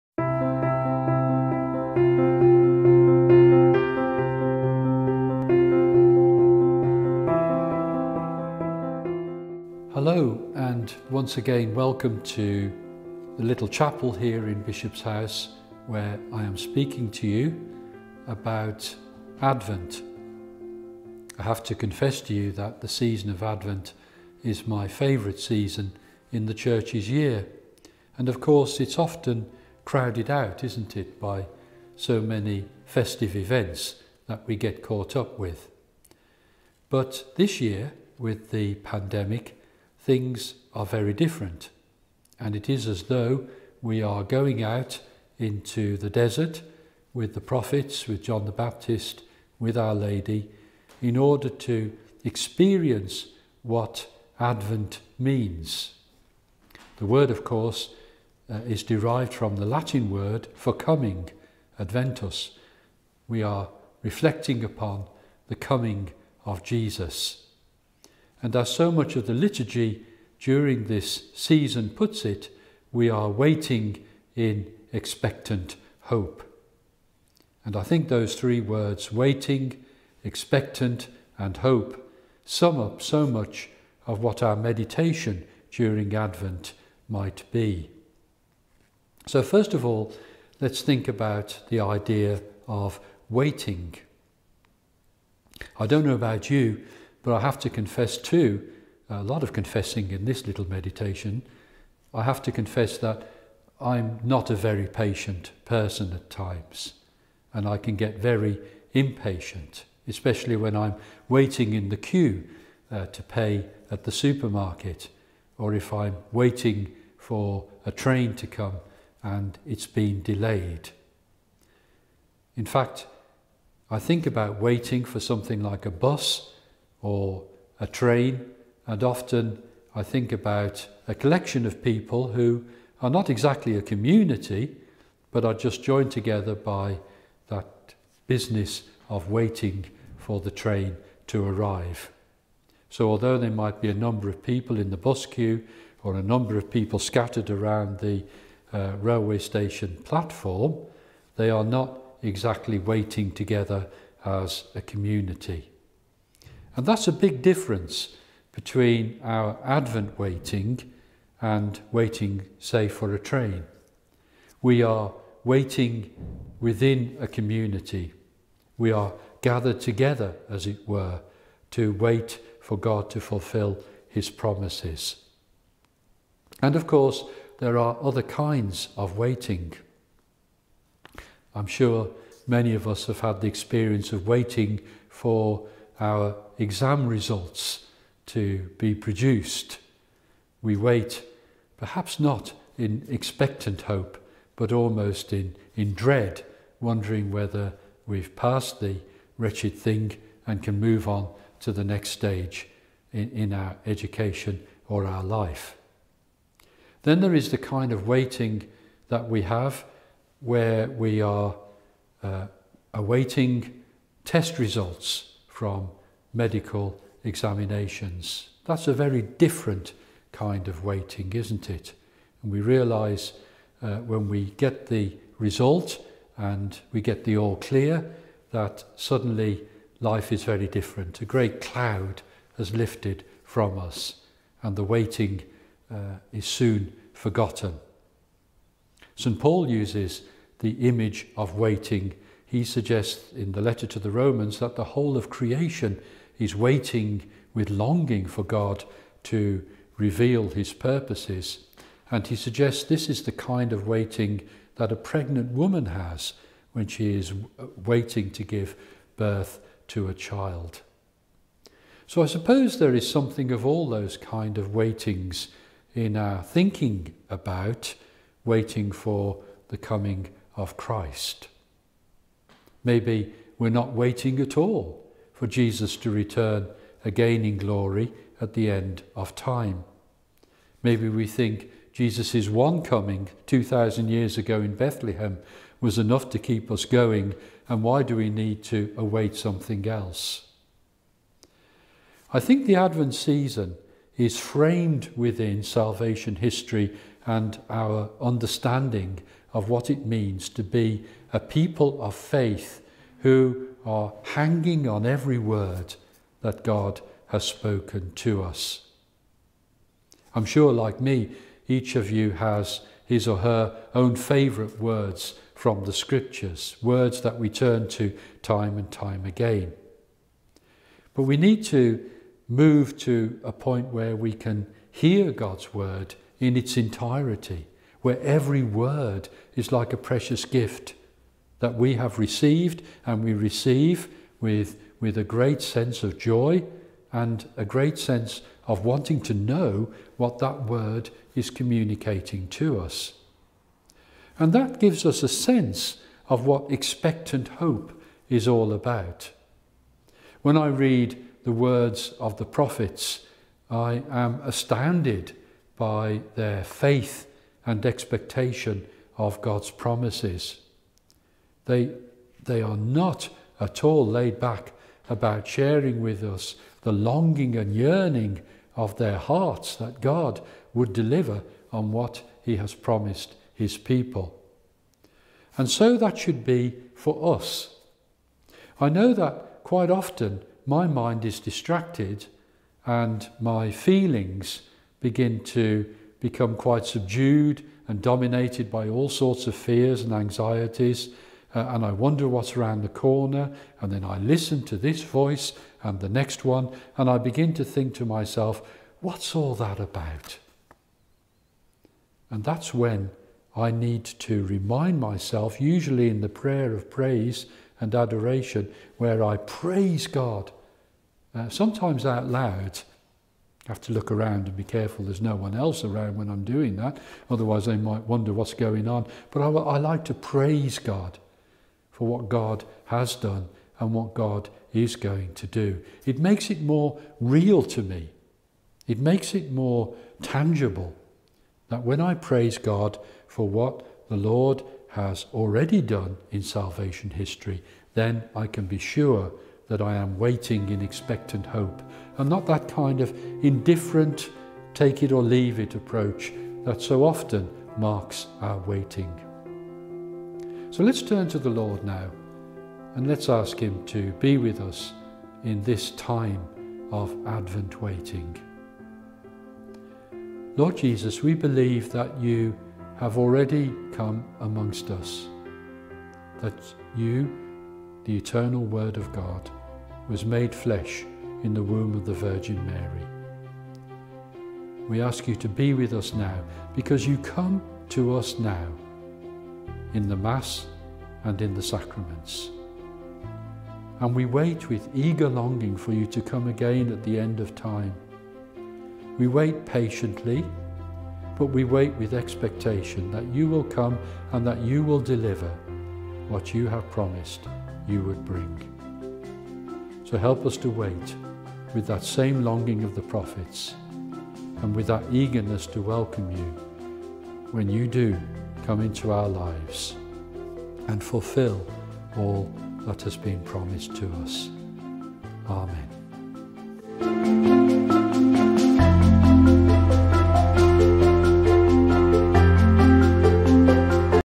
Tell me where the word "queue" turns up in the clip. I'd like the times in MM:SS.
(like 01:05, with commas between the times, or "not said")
01:51, 02:25.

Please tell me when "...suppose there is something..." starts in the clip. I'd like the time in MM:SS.
04:22.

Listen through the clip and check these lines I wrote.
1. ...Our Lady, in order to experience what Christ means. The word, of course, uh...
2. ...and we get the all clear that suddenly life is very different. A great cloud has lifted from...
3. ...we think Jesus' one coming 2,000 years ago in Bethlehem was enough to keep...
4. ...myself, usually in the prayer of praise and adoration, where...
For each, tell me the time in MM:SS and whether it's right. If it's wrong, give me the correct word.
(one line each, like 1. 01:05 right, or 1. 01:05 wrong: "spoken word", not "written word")
1. 00:49 wrong: "Advent", not "Christ"
2. 03:46 right
3. 04:41 right
4. 06:44 right.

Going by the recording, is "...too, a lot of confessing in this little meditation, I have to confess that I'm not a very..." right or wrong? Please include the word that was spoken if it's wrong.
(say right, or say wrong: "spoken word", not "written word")
right.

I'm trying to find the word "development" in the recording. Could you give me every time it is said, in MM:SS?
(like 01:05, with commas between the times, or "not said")
not said.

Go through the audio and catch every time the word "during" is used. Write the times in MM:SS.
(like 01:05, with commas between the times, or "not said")
01:10, 01:25.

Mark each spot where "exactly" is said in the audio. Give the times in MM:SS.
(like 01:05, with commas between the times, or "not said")
02:13, 02:32.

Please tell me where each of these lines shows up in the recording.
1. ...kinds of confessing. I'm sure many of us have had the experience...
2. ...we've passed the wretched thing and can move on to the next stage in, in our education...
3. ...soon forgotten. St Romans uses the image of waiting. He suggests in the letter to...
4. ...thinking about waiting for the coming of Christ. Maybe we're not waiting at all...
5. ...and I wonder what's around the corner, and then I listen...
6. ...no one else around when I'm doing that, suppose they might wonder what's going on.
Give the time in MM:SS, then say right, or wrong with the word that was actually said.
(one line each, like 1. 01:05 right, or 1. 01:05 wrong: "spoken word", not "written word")
1. 02:58 wrong: "waiting", not "confessing"
2. 03:18 right
3. 03:56 wrong: "Paul", not "Romans"
4. 04:26 right
5. 06:31 right
6. 06:55 wrong: "otherwise", not "suppose".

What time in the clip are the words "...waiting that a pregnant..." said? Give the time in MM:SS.
04:13.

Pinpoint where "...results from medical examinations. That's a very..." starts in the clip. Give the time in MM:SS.
03:34.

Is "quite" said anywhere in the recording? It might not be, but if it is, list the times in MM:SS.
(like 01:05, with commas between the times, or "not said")
06:19, 06:26.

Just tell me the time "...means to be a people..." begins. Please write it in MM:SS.
05:00.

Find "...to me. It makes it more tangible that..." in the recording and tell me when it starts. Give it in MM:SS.
07:07.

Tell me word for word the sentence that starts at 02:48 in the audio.
We are gathered together, as it were, to wait for God to fulfill his promises.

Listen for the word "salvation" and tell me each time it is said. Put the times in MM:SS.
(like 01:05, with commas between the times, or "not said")
04:55, 07:16.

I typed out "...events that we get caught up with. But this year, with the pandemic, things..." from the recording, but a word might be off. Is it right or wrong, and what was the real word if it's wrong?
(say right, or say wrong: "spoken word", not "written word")
right.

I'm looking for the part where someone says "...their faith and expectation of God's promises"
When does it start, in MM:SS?
05:56.